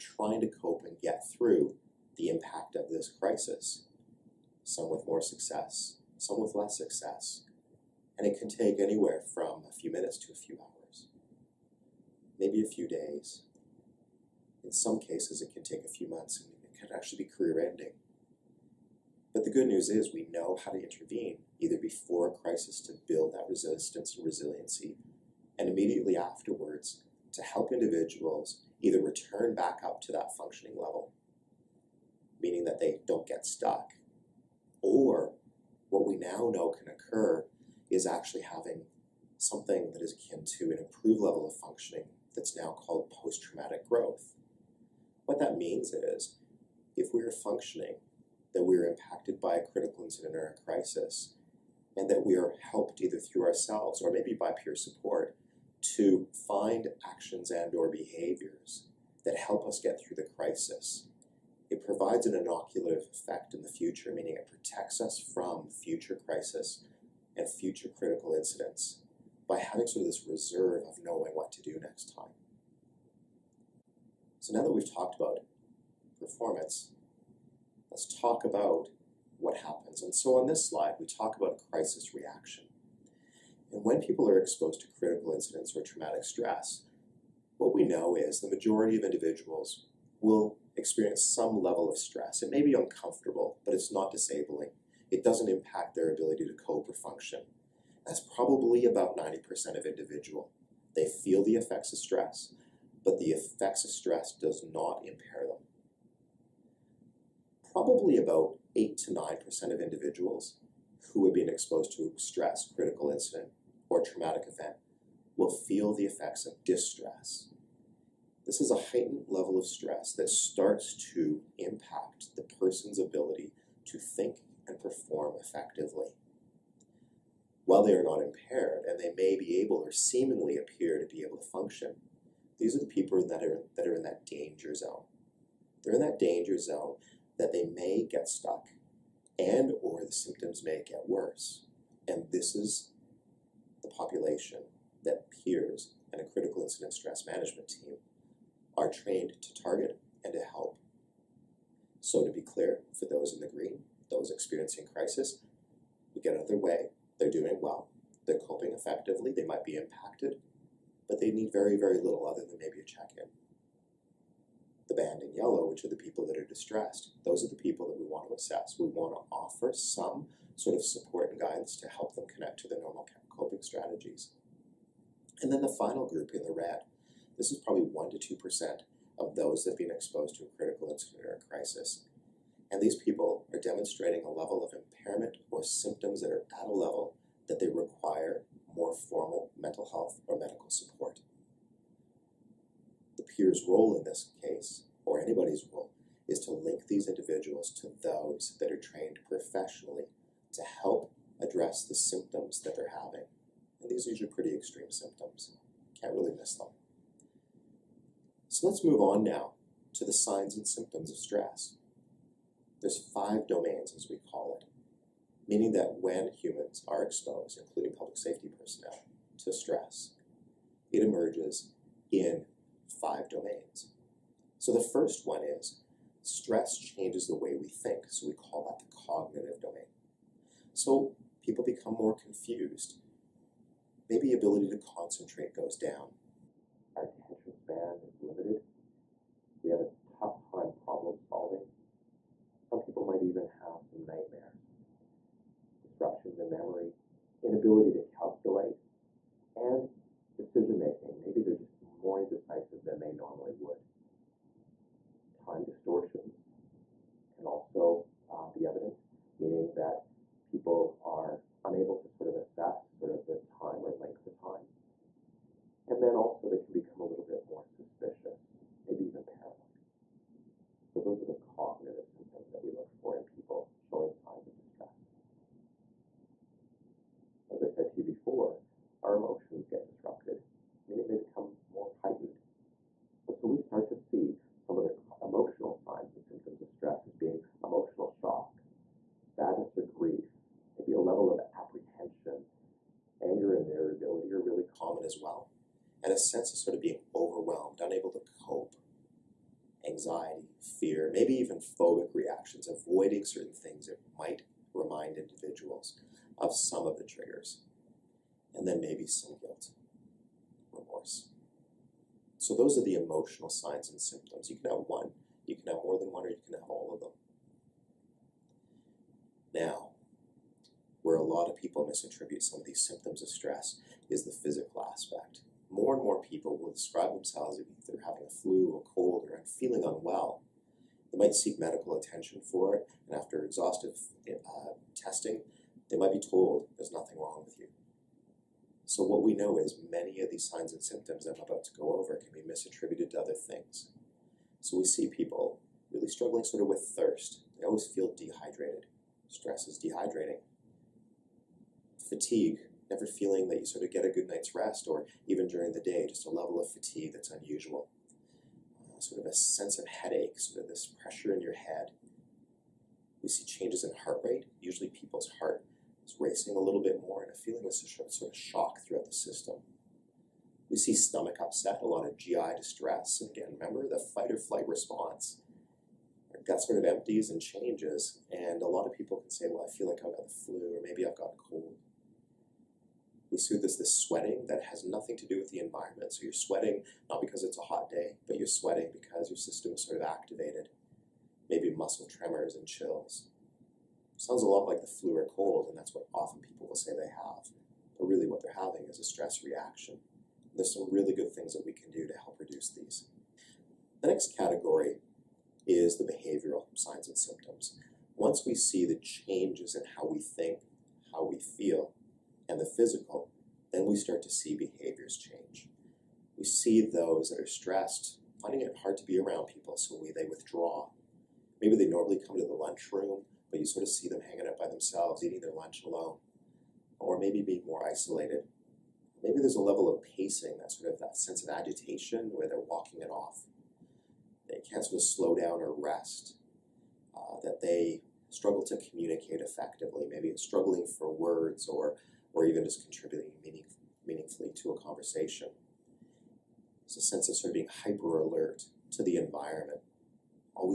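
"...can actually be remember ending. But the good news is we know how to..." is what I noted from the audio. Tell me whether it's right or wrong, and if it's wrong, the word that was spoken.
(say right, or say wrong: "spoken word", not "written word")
wrong: "career", not "remember".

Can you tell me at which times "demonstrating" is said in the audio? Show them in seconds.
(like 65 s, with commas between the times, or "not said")
183 s.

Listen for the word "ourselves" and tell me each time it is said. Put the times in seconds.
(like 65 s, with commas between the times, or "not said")
53 s.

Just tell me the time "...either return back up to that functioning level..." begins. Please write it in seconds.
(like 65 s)
28 s.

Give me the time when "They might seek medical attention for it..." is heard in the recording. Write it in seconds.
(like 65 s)
331 s.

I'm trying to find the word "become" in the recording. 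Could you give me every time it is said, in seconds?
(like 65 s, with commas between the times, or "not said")
231 s, 266 s, 281 s.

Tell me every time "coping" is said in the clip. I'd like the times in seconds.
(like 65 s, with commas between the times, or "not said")
158 s, 173 s.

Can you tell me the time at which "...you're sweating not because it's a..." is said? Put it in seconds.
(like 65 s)
386 s.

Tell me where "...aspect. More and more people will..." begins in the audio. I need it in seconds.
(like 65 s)
324 s.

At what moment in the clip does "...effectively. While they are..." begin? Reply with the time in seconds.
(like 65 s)
125 s.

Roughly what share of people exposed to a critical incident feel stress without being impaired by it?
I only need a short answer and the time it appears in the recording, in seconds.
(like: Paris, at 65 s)
90%, at 99 s.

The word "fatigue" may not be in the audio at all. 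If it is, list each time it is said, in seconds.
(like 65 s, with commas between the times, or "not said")
351 s, 356 s.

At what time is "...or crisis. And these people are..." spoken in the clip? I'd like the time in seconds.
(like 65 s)
181 s.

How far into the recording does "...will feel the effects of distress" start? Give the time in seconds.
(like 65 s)
115 s.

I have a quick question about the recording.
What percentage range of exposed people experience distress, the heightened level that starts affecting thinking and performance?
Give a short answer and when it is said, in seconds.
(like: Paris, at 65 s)
8 to 9%, at 108 s.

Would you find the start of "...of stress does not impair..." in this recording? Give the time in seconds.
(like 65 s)
103 s.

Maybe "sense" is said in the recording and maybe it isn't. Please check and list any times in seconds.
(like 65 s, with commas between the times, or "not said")
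296 s, 359 s, 431 s, 447 s.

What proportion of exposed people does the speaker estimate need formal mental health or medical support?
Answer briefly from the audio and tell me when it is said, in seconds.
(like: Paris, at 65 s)
1% to 2%, at 177 s.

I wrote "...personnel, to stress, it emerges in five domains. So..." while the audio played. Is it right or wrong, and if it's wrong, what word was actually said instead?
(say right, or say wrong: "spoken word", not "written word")
right.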